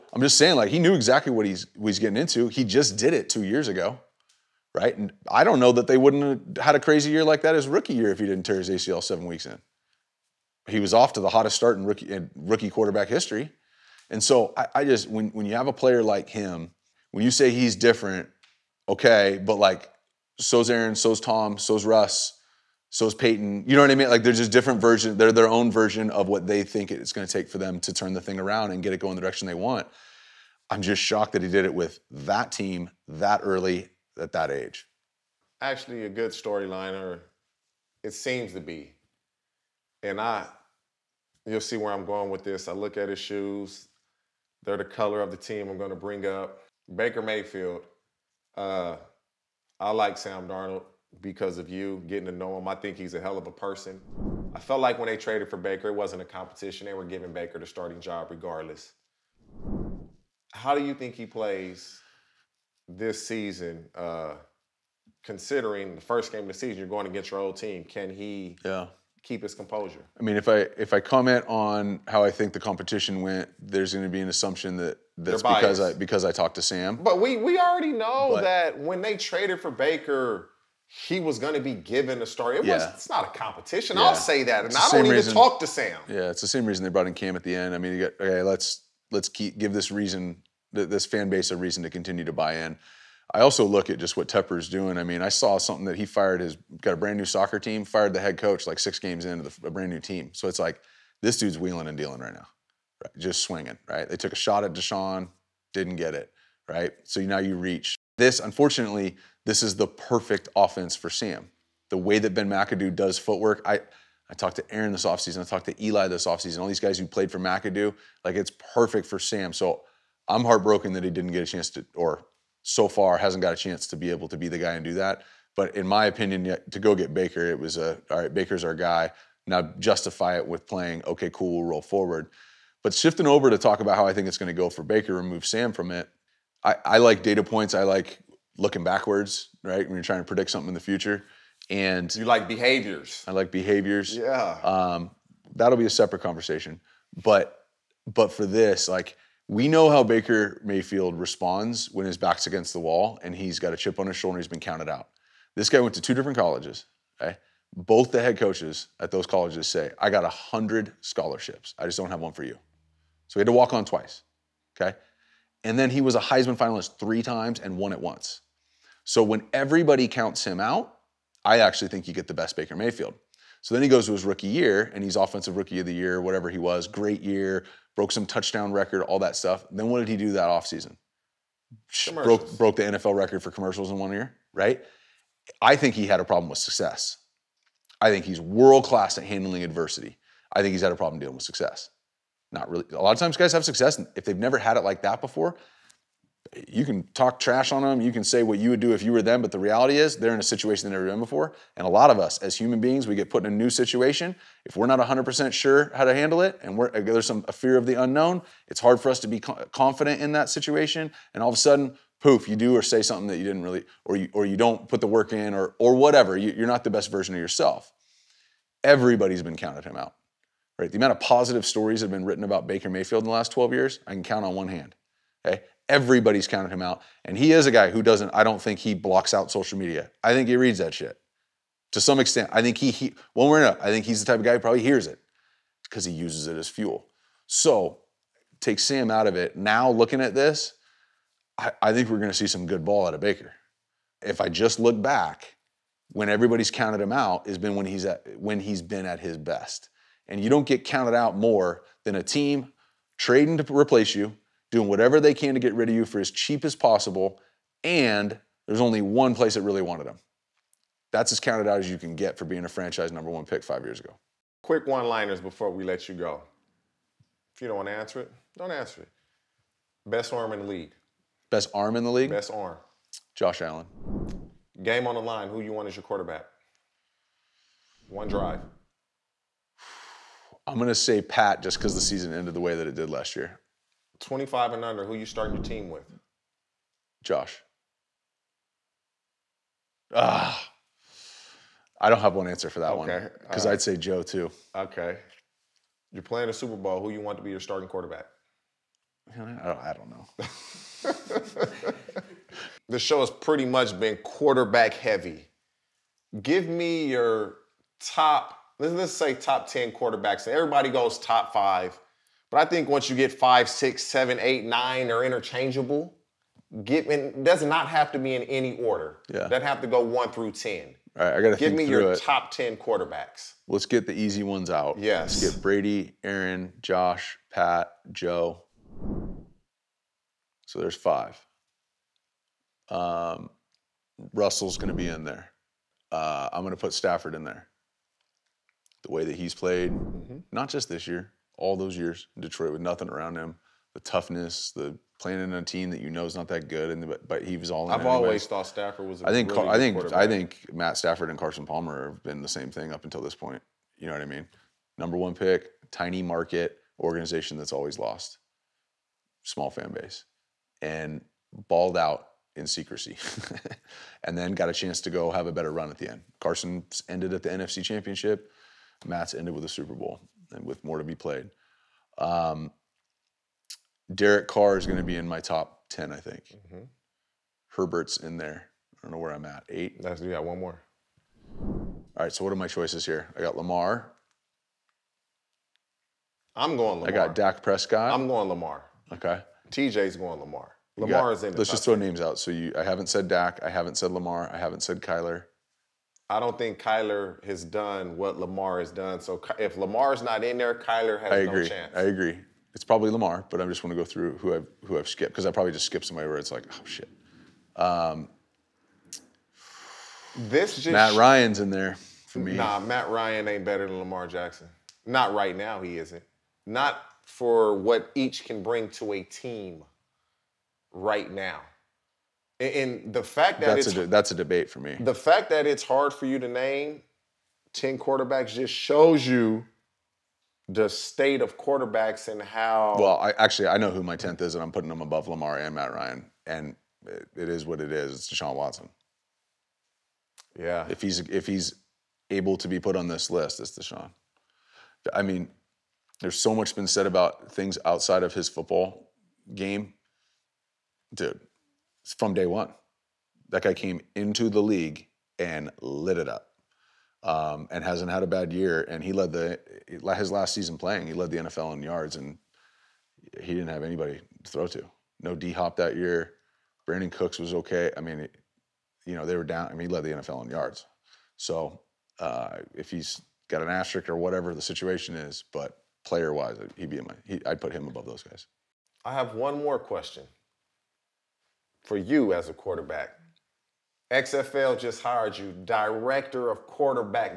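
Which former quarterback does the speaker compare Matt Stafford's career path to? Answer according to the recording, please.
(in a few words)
Carson Palmer.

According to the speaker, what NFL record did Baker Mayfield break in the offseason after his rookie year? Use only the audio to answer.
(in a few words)
Commercials in one year.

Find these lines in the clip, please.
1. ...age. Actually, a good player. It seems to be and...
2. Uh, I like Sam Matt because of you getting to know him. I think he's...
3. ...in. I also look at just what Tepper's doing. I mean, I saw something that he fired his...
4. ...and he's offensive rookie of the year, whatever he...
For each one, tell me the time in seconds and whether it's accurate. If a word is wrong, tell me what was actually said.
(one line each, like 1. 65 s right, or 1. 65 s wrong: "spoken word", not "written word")
1. 34 s wrong: "storyliner", not "player"
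2. 48 s wrong: "Darnold", not "Matt"
3. 92 s right
4. 174 s right.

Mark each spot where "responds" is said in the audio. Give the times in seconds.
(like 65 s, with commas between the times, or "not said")
151 s.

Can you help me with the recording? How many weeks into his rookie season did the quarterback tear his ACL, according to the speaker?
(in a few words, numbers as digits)
7.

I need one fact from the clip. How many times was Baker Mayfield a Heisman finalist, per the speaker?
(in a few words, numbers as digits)
3.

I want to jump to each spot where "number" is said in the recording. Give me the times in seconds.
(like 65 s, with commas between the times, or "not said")
263 s, 354 s.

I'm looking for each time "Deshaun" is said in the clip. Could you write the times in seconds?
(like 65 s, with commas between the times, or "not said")
104 s, 438 s, 443 s.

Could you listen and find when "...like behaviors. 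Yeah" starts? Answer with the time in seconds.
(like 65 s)
143 s.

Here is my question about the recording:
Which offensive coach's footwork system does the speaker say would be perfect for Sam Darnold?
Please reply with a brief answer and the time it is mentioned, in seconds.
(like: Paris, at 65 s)
Ben McAdoo, at 112 s.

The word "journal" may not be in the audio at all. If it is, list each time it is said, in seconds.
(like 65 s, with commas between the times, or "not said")
not said.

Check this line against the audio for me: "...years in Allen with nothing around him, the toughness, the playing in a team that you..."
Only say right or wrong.
wrong.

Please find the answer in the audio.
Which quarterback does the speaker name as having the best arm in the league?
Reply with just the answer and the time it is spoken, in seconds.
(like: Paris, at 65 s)
Josh Allen, at 273 s.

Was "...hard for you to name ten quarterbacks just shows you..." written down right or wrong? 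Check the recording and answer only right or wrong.
right.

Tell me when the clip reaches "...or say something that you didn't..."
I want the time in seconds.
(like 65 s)
212 s.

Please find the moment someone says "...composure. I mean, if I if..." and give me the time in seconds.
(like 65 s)
69 s.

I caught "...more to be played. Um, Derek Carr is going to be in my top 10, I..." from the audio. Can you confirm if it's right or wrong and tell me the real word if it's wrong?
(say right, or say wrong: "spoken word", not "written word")
right.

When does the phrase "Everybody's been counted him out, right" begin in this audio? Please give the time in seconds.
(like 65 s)
218 s.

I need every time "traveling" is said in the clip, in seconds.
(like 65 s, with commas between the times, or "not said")
not said.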